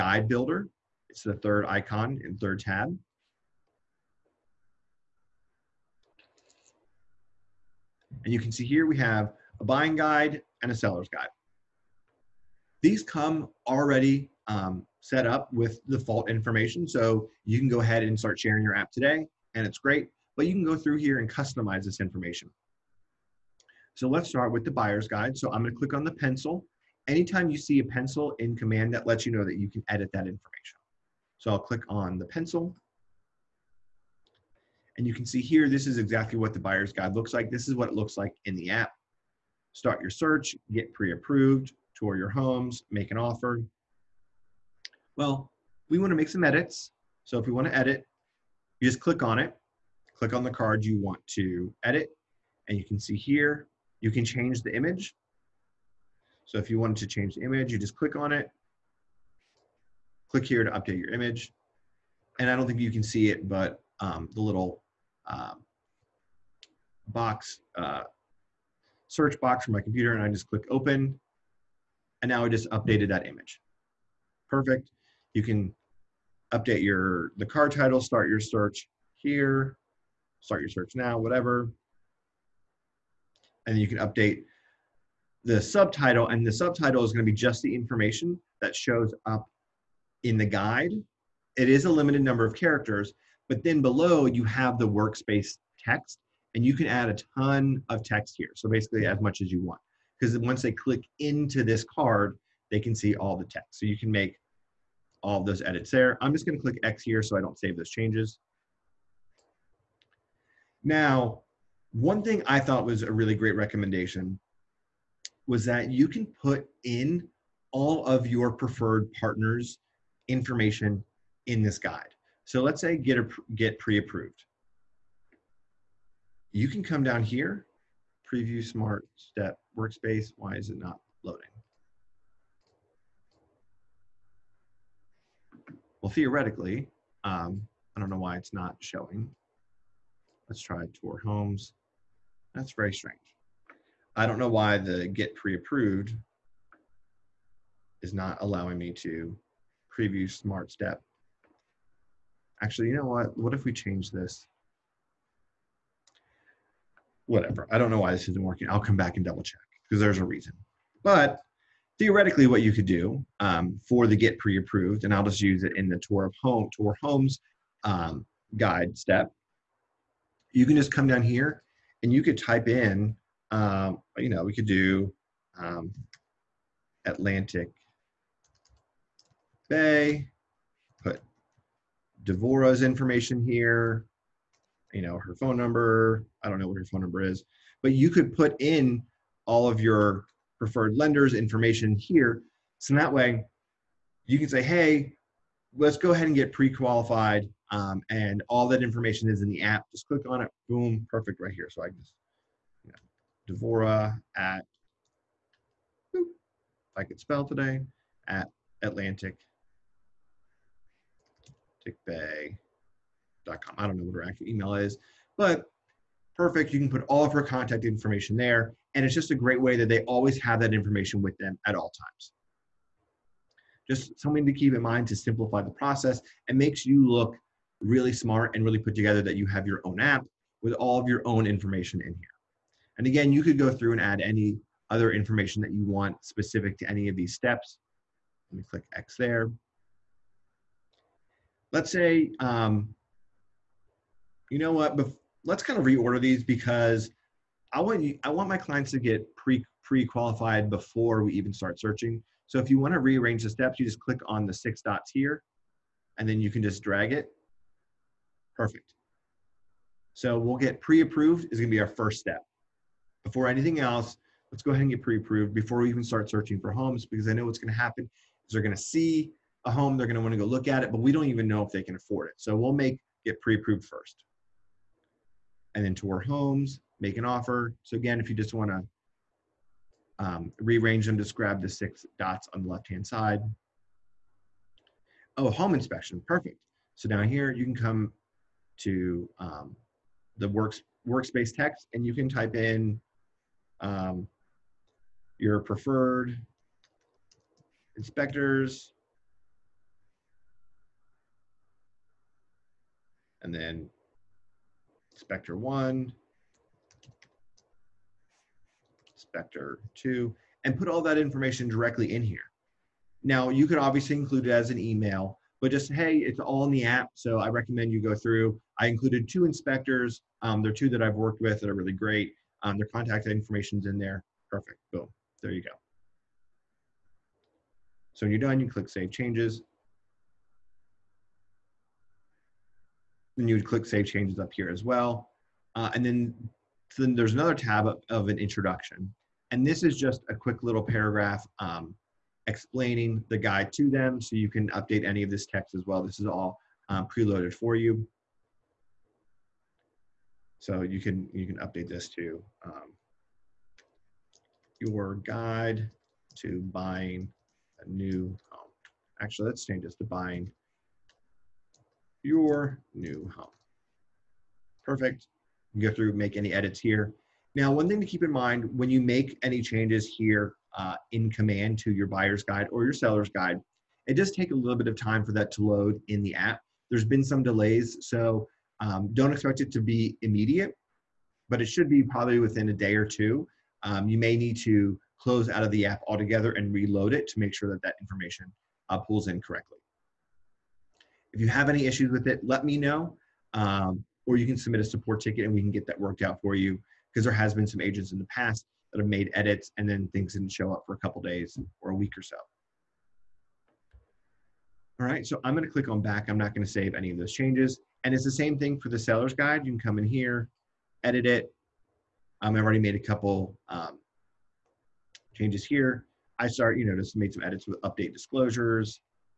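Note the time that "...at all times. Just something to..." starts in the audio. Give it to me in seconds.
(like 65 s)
221 s.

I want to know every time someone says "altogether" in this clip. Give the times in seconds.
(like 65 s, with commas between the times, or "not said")
386 s.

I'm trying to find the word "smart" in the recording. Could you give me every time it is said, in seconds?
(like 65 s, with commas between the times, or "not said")
128 s, 150 s, 228 s.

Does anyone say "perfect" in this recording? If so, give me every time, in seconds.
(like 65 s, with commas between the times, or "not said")
74 s, 201 s, 216 s, 258 s, 286 s, 324 s, 364 s.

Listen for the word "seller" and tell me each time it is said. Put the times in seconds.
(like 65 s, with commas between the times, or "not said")
10 s, 372 s, 408 s.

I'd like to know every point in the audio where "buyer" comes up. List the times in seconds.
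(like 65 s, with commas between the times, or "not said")
24 s, 36 s, 372 s.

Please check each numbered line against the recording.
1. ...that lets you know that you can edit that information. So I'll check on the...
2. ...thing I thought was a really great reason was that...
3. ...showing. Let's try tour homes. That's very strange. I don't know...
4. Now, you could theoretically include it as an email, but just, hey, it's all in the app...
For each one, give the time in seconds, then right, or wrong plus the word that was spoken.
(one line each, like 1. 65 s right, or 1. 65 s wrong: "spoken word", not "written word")
1. 28 s wrong: "click", not "check"
2. 112 s wrong: "recommendation", not "reason"
3. 138 s right
4. 313 s wrong: "obviously", not "theoretically".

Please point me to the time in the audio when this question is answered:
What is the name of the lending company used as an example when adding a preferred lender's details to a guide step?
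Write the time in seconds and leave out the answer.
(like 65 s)
177 s.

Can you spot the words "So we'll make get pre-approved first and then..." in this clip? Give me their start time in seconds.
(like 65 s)
272 s.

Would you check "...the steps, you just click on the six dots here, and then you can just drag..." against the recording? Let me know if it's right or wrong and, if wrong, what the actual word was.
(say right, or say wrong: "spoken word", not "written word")
right.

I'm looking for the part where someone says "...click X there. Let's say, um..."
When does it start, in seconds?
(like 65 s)
238 s.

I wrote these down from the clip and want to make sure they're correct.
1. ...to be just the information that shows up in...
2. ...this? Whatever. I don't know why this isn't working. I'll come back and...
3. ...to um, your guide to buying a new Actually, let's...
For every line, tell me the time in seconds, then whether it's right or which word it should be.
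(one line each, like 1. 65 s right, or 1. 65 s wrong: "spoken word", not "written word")
1. 87 s right
2. 154 s right
3. 352 s right.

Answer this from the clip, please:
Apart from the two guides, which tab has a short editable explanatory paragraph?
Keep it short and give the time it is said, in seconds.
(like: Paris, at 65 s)
introduction, at 338 s.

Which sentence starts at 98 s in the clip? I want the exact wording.
So basically, as much as you want, because once they click into this card, they can see all the text.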